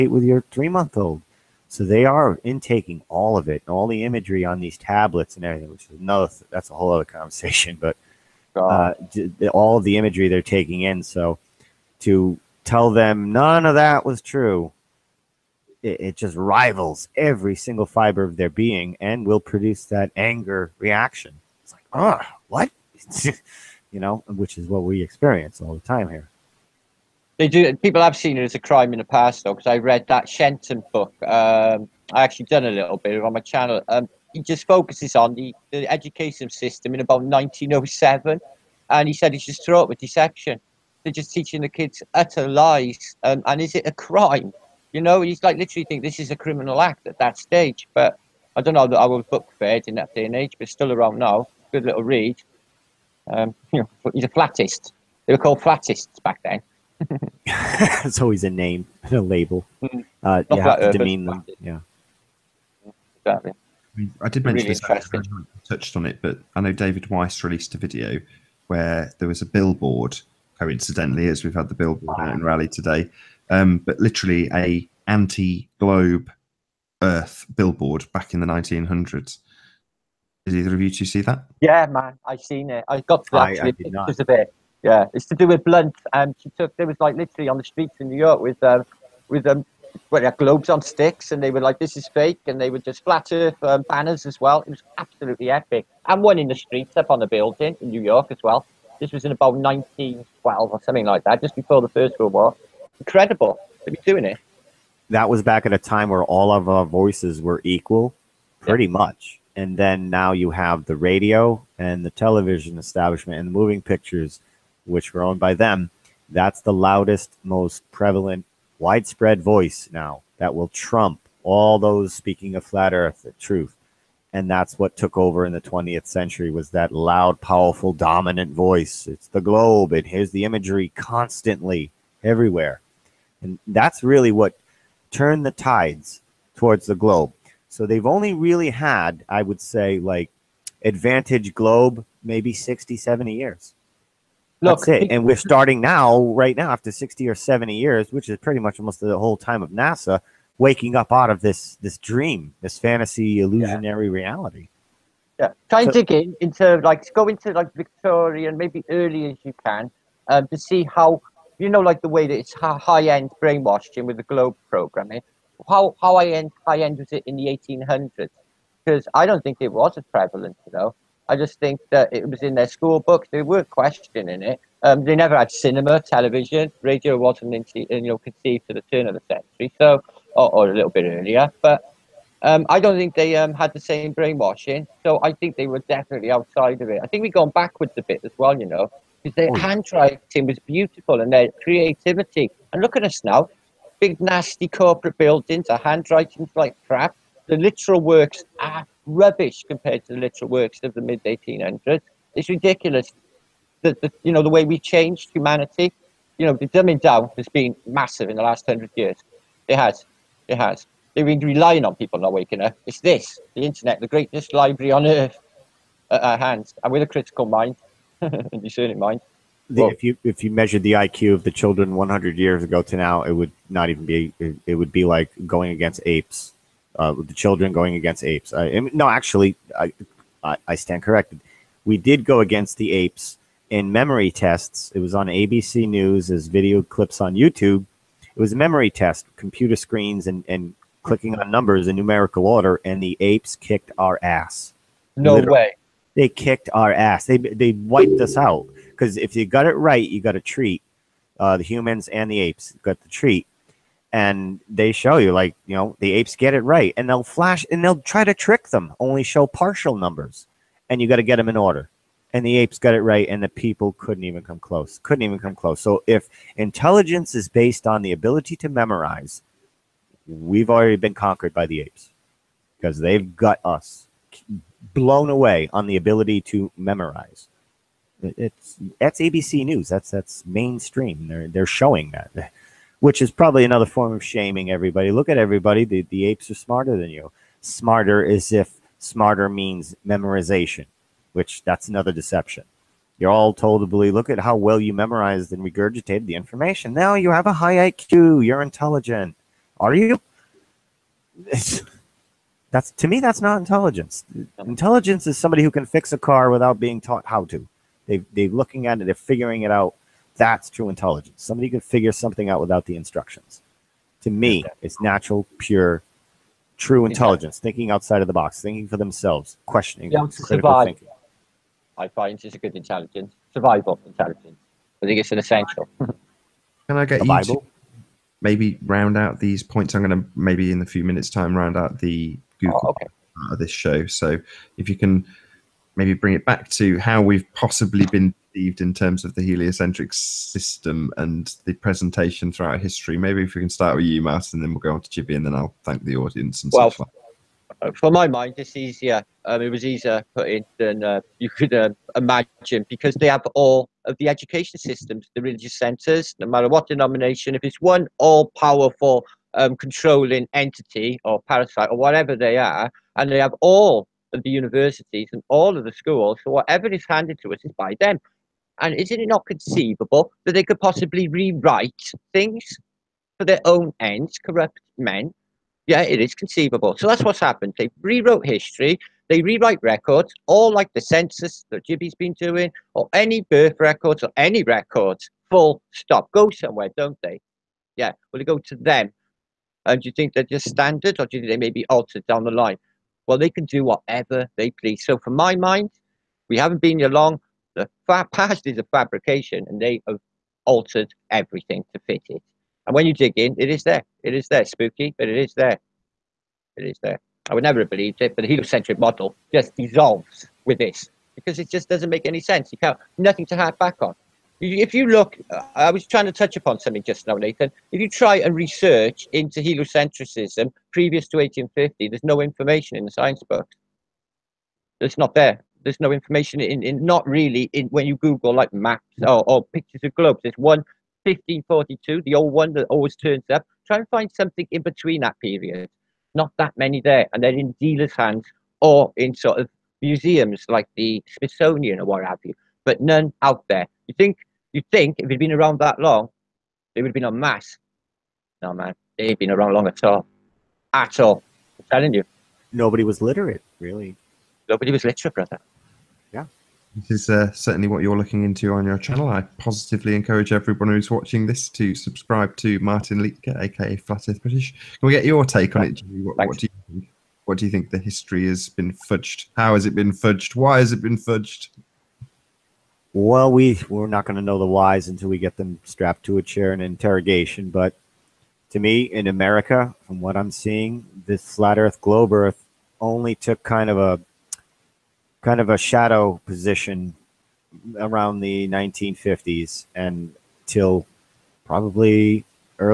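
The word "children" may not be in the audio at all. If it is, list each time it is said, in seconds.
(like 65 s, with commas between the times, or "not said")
221 s, 227 s.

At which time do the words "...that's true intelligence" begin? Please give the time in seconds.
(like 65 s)
310 s.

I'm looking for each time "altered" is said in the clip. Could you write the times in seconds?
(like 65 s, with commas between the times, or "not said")
391 s, 400 s.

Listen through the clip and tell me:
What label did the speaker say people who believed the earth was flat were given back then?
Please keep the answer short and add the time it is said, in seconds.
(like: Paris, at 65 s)
flattists, at 55 s.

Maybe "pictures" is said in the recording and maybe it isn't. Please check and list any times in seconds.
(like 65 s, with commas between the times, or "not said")
83 s, 113 s, 429 s.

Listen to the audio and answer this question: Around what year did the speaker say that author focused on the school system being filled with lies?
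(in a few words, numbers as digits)
1907.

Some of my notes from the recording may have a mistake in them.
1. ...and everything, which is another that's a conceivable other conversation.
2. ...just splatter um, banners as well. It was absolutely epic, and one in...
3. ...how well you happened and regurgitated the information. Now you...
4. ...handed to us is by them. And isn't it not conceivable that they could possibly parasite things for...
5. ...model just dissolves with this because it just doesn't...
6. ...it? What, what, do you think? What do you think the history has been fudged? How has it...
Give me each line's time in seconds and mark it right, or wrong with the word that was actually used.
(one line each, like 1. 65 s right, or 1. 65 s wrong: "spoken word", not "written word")
1. 5 s wrong: "whole", not "conceivable"
2. 92 s right
3. 294 s wrong: "memorized", not "happened"
4. 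367 s wrong: "rewrite", not "parasite"
5. 408 s right
6. 465 s right.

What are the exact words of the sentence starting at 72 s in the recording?
out in Rally today, um, but literally a anti-globe Earth billboard back in the 1900s.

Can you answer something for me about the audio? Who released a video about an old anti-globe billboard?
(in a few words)
David Weiss.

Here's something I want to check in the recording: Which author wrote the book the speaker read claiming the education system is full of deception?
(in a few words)
Shenton.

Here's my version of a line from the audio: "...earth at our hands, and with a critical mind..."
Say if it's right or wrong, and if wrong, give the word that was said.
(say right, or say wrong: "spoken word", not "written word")
right.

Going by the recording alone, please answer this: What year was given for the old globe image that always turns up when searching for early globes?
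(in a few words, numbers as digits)
1542.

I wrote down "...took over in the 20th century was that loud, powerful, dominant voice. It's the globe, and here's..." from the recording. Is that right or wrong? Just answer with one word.
right.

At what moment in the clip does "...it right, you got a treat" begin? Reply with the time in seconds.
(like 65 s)
249 s.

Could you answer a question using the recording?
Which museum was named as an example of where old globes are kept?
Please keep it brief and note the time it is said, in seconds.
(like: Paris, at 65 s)
Smithsonian, at 441 s.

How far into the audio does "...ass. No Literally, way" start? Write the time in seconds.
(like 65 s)
244 s.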